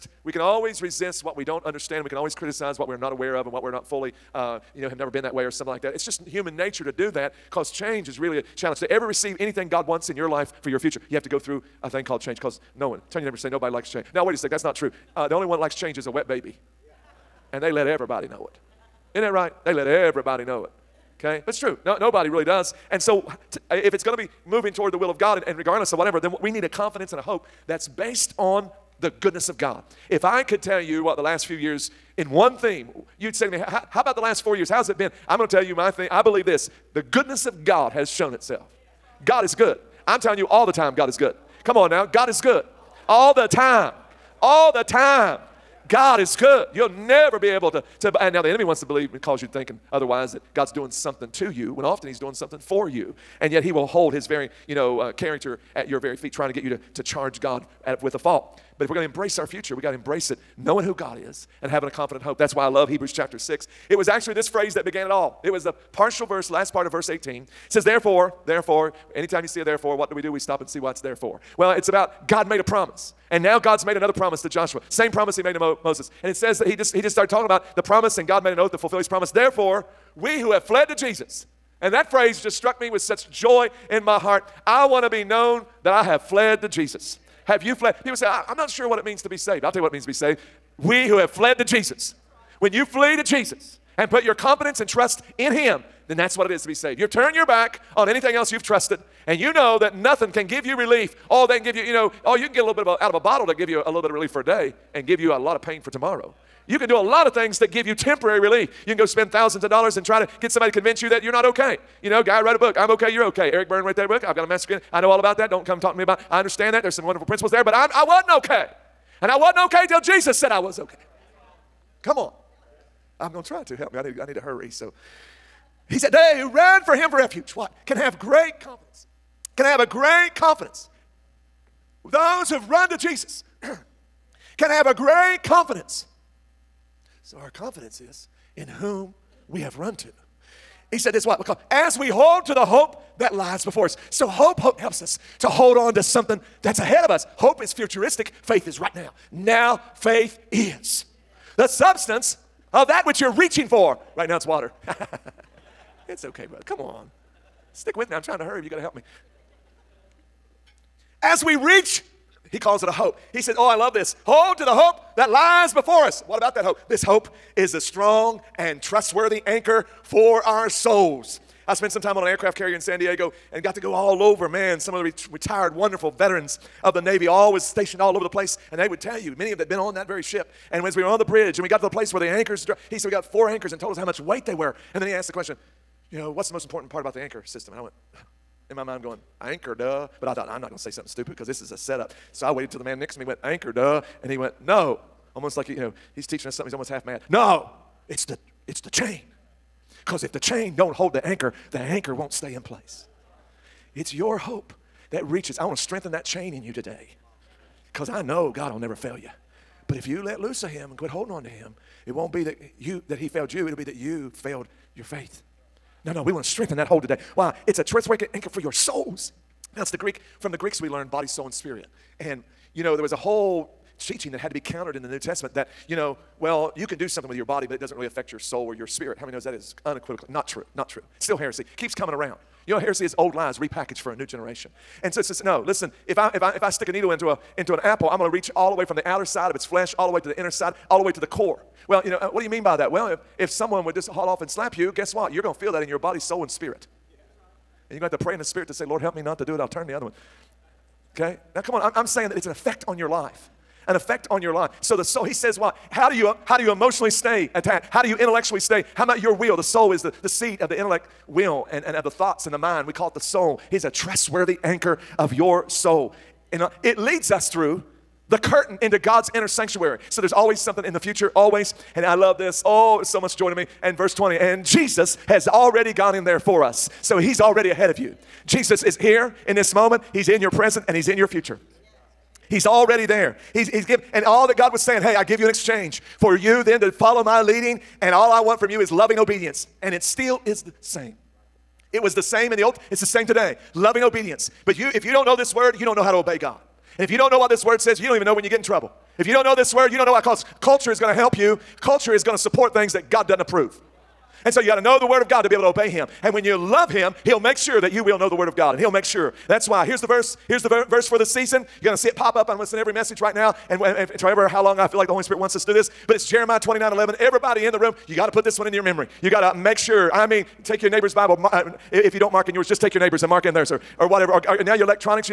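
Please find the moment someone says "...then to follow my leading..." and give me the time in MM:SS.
04:46.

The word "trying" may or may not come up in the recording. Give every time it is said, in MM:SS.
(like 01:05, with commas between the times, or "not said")
00:56, 02:38.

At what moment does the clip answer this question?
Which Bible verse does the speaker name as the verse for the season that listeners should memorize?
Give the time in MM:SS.
05:16.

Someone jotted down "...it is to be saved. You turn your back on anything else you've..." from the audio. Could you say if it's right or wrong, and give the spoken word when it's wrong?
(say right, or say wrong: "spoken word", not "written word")
right.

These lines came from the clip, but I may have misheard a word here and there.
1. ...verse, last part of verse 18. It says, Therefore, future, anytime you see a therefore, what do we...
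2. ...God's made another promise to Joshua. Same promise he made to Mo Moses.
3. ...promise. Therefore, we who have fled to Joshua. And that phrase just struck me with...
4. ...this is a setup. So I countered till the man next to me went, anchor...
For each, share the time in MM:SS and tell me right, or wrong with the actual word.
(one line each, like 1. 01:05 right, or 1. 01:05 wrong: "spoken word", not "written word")
1. 01:06 wrong: "therefore", not "future"
2. 01:13 right
3. 01:19 wrong: "Jesus", not "Joshua"
4. 03:11 wrong: "waited", not "countered".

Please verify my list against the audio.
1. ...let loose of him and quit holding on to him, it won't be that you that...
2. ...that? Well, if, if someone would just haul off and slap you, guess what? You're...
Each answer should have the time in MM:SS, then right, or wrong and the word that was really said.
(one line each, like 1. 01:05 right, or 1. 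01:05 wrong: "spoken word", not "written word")
1. 03:30 right
2. 04:02 right.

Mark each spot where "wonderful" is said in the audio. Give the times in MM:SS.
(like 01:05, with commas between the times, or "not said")
01:57, 02:55.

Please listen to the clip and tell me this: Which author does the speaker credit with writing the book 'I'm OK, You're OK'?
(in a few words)
Eric Berne.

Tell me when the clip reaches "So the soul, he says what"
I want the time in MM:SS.
04:14.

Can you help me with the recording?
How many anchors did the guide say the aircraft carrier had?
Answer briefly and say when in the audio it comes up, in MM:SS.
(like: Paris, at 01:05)
4, at 03:03.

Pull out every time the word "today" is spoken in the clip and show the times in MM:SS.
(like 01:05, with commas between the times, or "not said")
03:26, 03:37, 04:53.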